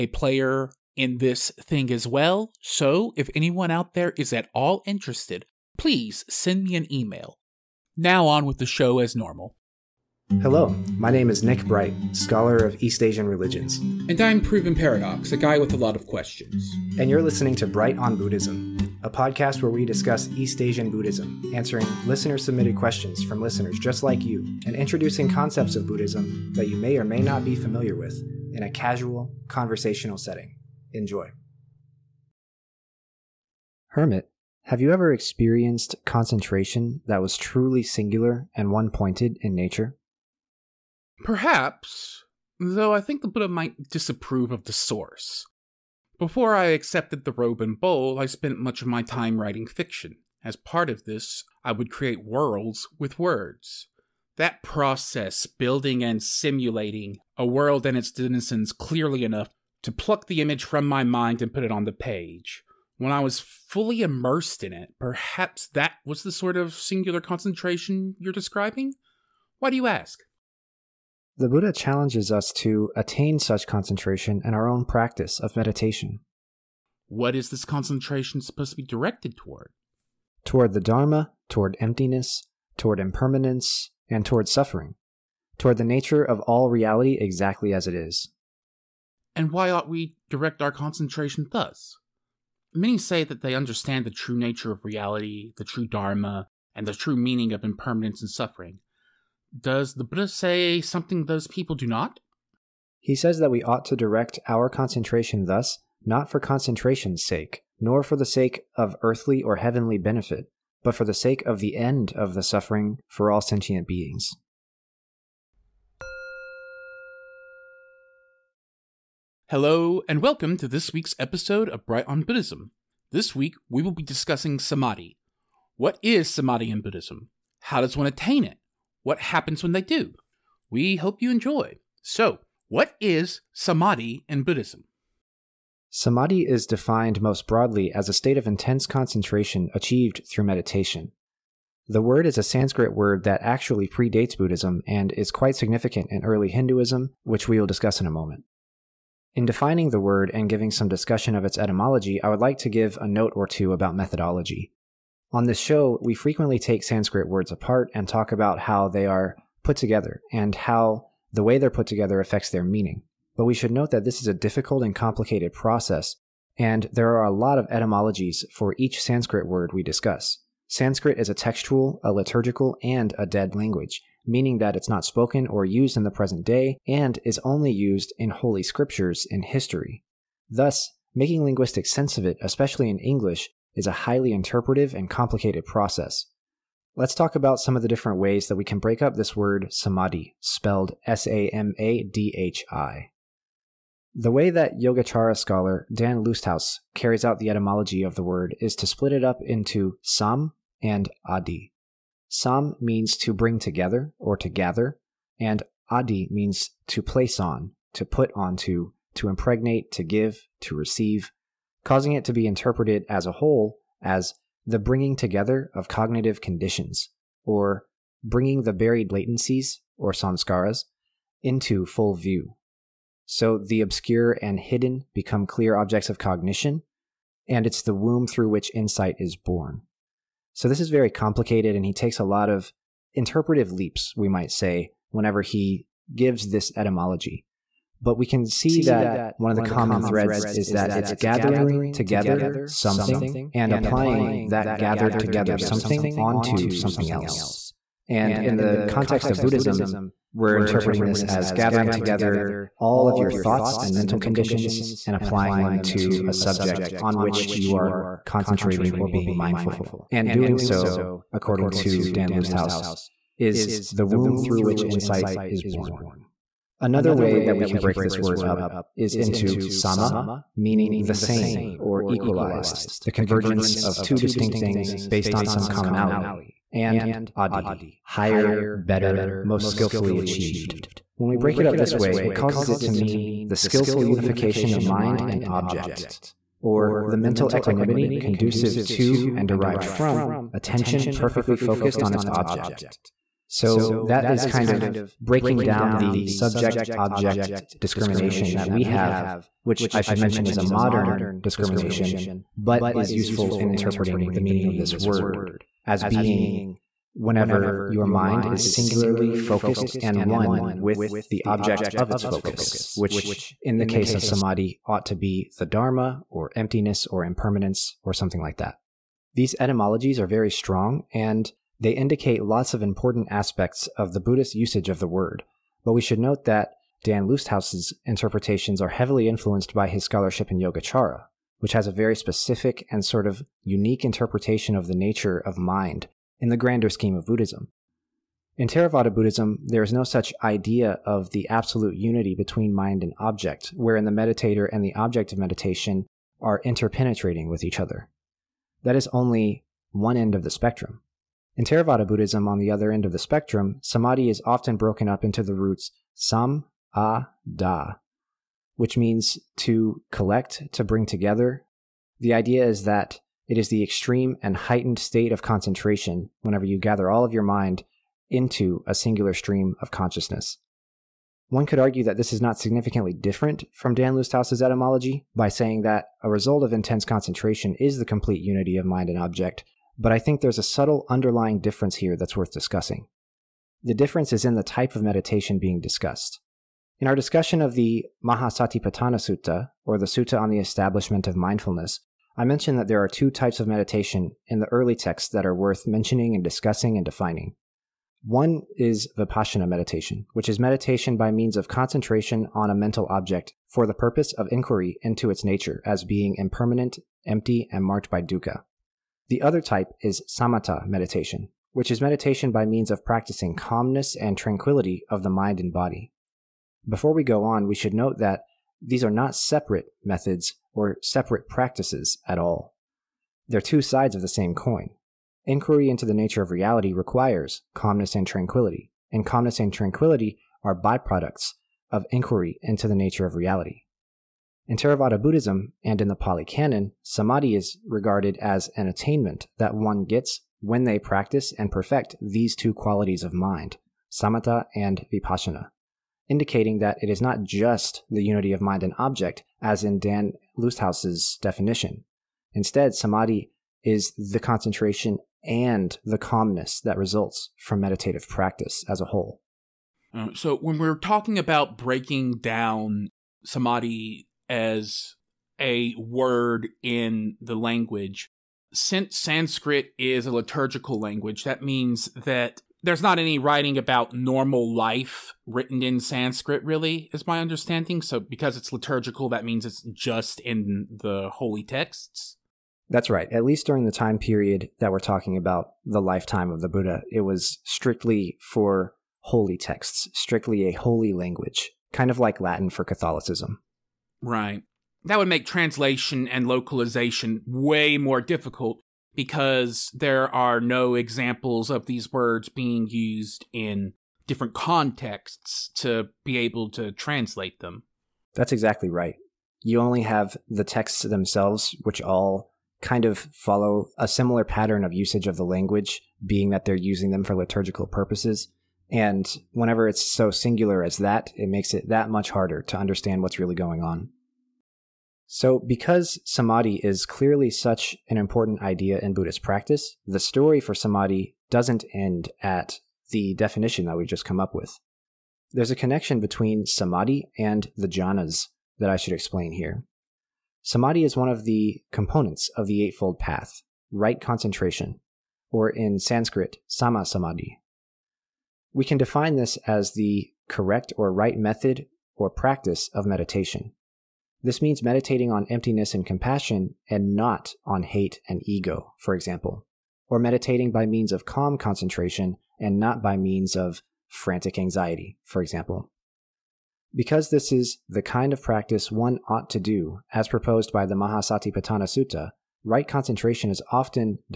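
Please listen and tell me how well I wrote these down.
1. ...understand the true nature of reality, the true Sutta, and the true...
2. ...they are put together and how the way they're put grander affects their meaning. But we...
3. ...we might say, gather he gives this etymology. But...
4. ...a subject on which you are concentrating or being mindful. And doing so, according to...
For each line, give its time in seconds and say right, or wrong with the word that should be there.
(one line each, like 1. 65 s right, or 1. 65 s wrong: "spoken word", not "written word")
1. 93 s wrong: "Dharma", not "Sutta"
2. 158 s wrong: "together", not "grander"
3. 234 s wrong: "whenever", not "gather"
4. 256 s right.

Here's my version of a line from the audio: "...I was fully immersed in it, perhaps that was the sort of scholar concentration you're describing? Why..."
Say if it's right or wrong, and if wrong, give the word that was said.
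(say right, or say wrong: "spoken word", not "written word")
wrong: "singular", not "scholar".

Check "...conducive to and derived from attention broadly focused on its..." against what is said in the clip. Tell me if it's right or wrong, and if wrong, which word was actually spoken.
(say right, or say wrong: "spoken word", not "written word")
wrong: "perfectly", not "broadly".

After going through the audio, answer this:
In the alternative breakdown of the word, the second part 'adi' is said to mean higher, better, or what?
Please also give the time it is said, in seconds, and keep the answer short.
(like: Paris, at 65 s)
Most skillfully achieved, at 279 s.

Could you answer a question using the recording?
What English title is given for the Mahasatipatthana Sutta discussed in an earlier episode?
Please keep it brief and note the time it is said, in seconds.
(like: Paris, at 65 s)
Sutta on the Establishment of Mindfulness, at 390 s.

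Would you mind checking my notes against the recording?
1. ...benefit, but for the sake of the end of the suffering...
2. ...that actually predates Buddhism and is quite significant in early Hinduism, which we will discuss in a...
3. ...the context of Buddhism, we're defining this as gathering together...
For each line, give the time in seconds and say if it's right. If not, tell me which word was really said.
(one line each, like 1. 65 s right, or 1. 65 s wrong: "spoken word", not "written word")
1. 109 s right
2. 143 s right
3. 248 s wrong: "interpreting", not "defining".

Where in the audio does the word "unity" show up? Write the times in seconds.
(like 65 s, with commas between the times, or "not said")
341 s, 378 s, 448 s.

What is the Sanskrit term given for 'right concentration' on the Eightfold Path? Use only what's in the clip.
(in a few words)
Sama samadhi.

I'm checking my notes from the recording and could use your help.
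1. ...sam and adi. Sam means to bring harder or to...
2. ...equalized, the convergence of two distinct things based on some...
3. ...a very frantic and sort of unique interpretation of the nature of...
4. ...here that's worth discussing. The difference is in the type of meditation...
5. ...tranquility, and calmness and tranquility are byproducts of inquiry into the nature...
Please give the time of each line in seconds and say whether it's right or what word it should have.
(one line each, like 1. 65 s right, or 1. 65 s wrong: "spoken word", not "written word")
1. 200 s wrong: "together", not "harder"
2. 272 s right
3. 331 s wrong: "specific", not "frantic"
4. 381 s right
5. 428 s right.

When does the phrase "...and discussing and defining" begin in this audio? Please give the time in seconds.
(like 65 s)
396 s.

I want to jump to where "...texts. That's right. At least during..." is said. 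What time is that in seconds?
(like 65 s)
481 s.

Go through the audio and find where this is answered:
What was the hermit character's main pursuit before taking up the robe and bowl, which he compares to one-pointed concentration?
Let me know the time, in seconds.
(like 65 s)
49 s.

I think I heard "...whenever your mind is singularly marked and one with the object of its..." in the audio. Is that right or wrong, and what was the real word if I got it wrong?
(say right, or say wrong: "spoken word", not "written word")
wrong: "focused", not "marked".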